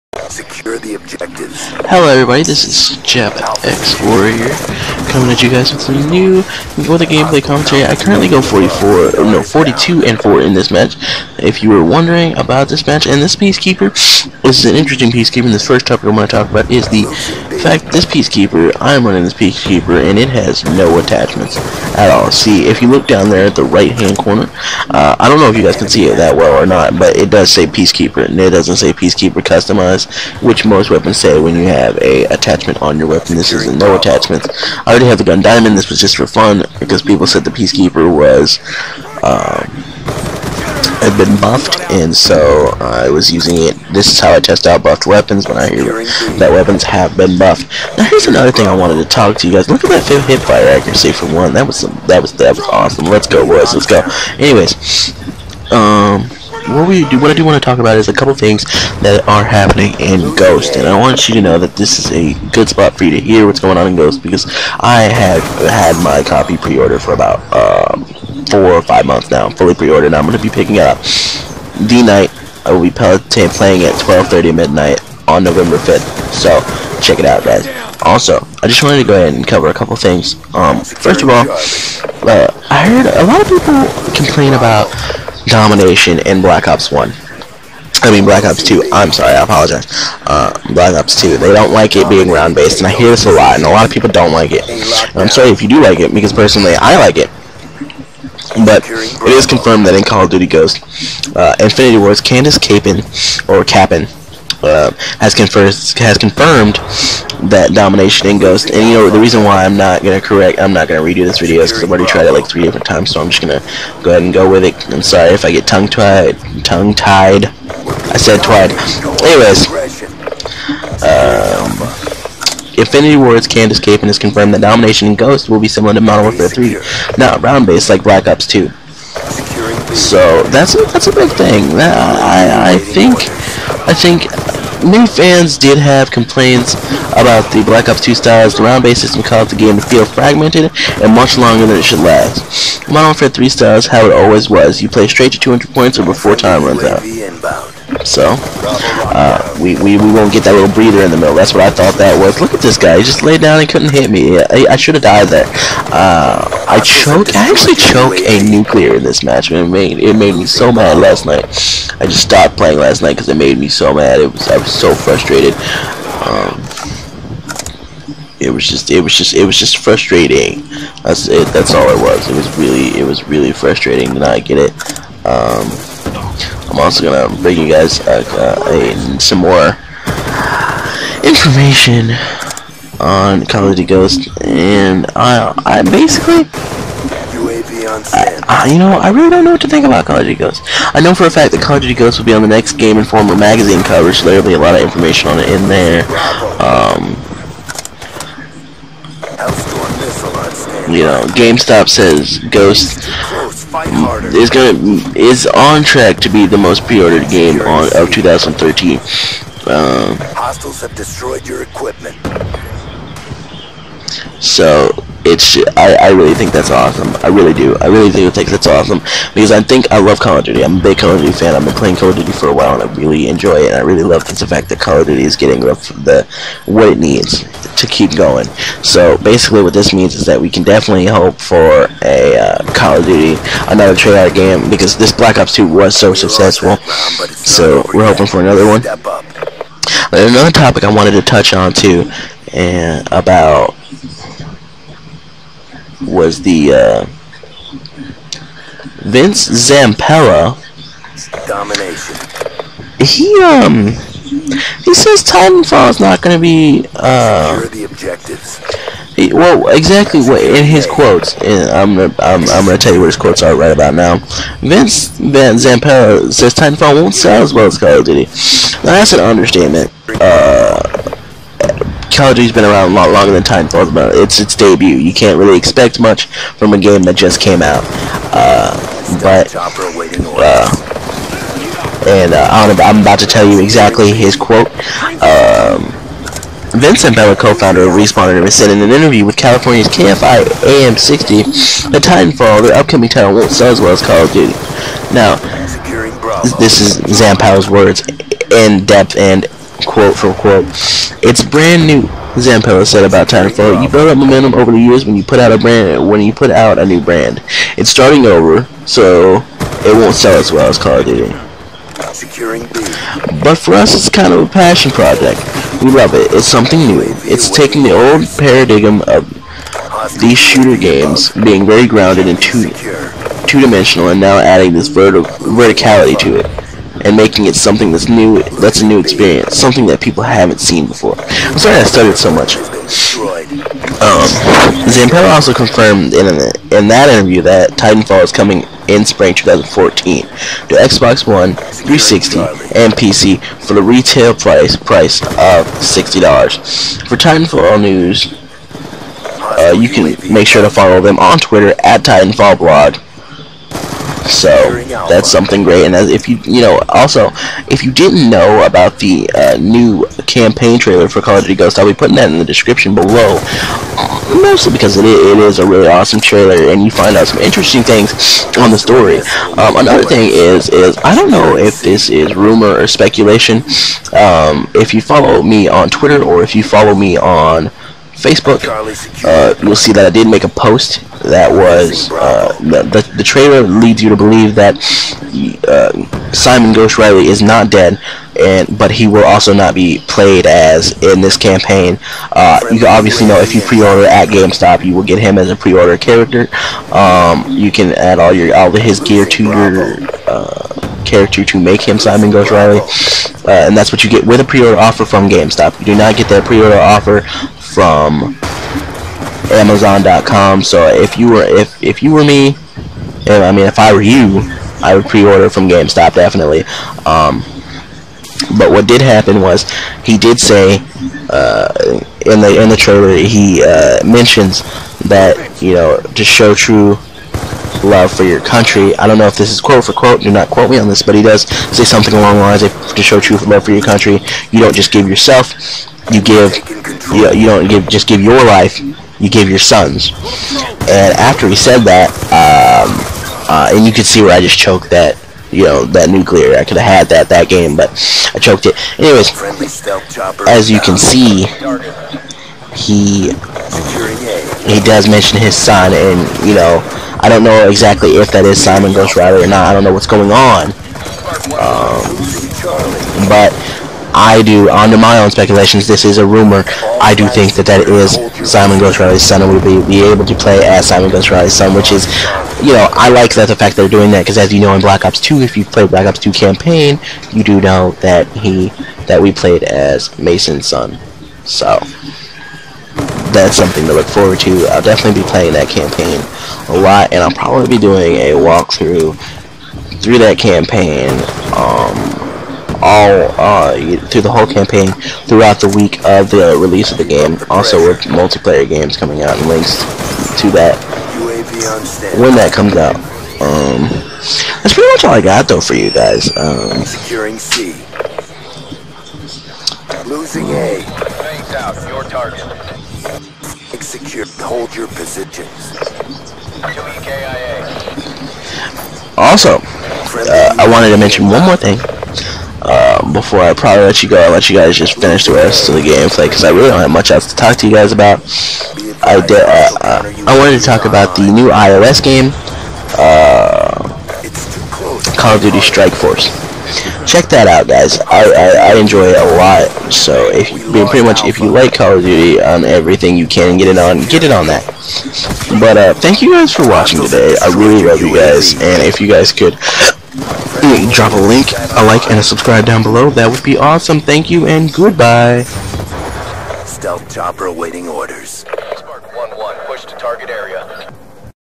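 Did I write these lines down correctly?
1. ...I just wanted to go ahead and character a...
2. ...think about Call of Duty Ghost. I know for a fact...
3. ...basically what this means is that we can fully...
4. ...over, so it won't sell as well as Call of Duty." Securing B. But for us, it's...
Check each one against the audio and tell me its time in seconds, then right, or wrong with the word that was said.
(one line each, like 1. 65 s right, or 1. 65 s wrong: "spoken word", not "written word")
1. 78 s wrong: "cover", not "character"
2. 189 s right
3. 229 s wrong: "definitely", not "fully"
4. 308 s right.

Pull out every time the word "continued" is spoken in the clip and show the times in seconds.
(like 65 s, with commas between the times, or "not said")
not said.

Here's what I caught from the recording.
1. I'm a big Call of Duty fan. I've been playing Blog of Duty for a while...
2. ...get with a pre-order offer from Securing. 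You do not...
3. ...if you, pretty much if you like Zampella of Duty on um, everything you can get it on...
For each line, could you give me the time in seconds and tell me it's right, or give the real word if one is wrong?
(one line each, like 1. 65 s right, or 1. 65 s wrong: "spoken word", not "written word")
1. 220 s wrong: "Call", not "Blog"
2. 404 s wrong: "GameStop", not "Securing"
3. 540 s wrong: "Call", not "Zampella".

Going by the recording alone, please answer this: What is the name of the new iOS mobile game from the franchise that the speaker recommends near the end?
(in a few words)
Call of Duty Strike Force.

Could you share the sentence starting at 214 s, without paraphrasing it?
So it's I, I really think that's awesome.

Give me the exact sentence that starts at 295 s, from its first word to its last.
Now, this is Zampow's words in depth and quote for quote.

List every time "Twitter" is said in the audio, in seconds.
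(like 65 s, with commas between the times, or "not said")
351 s, 375 s.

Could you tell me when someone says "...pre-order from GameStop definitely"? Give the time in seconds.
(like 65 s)
415 s.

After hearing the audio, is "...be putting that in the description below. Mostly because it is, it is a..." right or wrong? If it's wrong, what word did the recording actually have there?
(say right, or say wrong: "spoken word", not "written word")
right.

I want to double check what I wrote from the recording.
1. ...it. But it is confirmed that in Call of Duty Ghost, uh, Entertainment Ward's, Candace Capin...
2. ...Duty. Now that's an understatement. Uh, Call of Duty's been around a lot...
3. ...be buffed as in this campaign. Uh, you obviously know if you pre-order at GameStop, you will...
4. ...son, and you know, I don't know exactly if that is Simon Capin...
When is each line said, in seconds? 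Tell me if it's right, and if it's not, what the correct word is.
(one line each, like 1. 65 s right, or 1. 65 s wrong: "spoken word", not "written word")
1. 97 s wrong: "Infinity", not "Entertainment"
2. 268 s right
3. 389 s wrong: "played", not "buffed"
4. 455 s wrong: "Ghost", not "Capin".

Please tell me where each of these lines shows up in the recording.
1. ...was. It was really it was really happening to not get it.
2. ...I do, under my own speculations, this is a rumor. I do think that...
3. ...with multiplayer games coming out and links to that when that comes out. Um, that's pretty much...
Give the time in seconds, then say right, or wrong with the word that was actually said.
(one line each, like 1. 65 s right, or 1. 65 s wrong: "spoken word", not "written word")
1. 172 s wrong: "frustrating", not "happening"
2. 464 s right
3. 497 s right.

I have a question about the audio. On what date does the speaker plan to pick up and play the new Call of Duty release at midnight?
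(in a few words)
November 5th.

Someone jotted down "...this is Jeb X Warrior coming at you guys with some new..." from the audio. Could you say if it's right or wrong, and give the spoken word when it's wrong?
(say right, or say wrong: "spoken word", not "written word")
right.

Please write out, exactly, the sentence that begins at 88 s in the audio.
I mean Black Ops 2, I'm sorry, I apologize.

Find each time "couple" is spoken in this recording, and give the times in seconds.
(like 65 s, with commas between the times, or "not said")
58 s, 79 s.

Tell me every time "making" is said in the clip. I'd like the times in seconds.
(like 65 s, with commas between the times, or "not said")
327 s.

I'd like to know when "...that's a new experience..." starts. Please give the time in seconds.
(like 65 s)
328 s.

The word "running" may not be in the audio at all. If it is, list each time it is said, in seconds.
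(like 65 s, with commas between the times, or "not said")
19 s.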